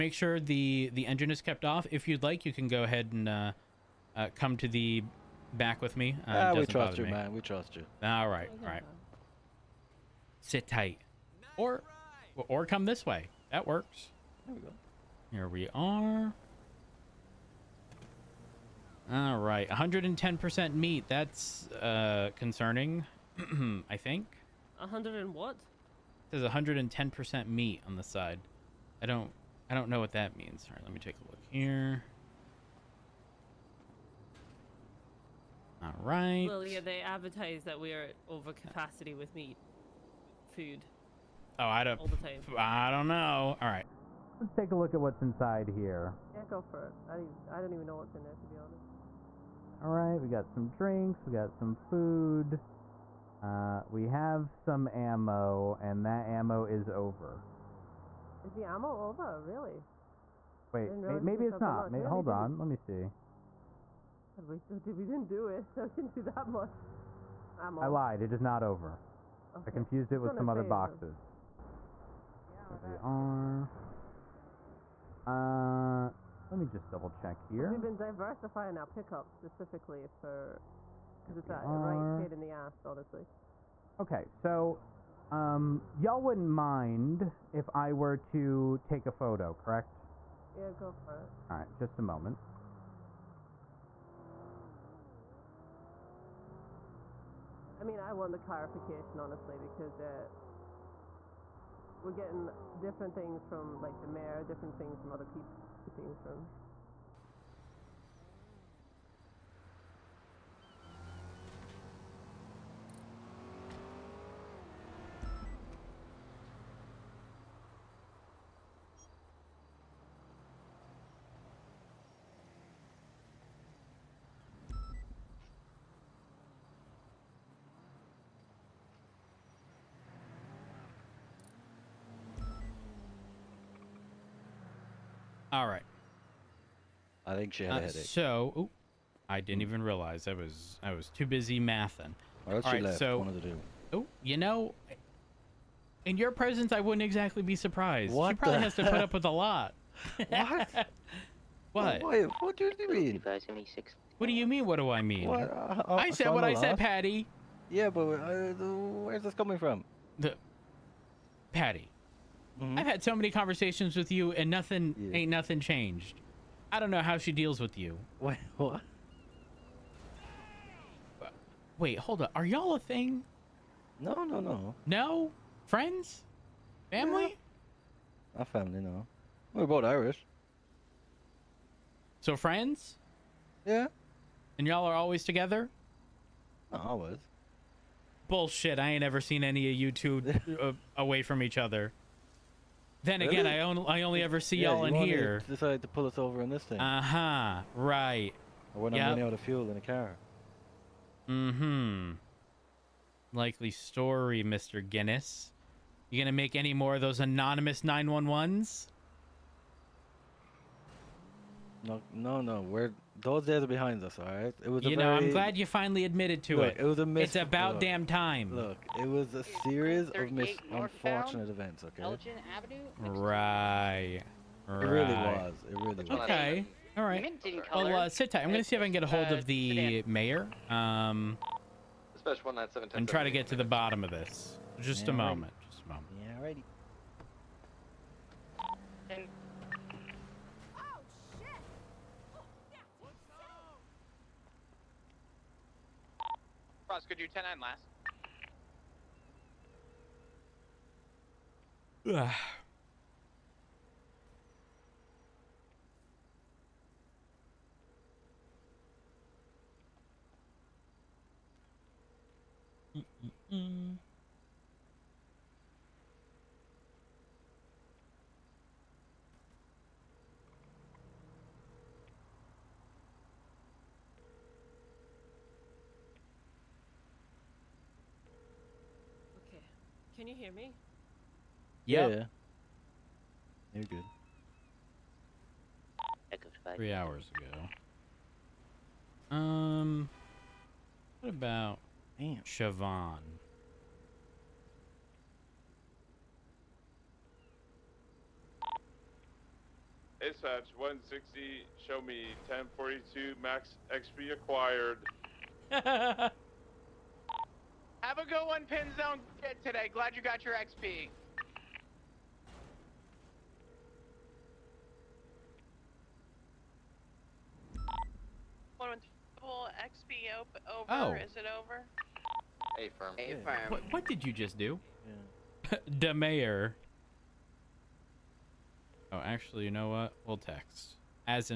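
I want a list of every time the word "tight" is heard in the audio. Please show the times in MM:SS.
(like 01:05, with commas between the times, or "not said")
00:10, 03:48.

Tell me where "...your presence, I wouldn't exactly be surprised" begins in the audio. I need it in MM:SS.
02:26.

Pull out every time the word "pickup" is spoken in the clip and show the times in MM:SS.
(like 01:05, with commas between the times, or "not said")
01:18.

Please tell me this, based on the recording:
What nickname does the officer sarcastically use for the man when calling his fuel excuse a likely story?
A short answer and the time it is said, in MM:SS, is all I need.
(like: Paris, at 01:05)
Mr. Guinness, at 03:24.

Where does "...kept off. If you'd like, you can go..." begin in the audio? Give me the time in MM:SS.
00:01.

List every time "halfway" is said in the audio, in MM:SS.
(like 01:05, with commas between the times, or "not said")
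not said.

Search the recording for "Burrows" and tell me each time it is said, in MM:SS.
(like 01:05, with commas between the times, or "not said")
not said.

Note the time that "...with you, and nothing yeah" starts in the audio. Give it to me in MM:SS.
02:43.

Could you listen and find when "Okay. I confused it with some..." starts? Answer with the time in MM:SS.
01:09.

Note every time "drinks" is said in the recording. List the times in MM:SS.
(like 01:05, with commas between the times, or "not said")
00:50.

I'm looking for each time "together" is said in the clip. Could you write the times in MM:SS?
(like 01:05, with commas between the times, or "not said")
03:05.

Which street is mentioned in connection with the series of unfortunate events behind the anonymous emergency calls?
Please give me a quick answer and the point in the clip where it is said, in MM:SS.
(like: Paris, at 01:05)
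Elgin Avenue, at 03:42.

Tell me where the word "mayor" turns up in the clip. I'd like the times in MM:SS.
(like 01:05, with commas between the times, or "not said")
01:44, 03:50, 05:26.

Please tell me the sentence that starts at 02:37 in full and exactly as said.
Yeah, but uh, where's this coming from?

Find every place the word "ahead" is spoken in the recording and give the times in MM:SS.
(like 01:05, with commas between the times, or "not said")
00:02.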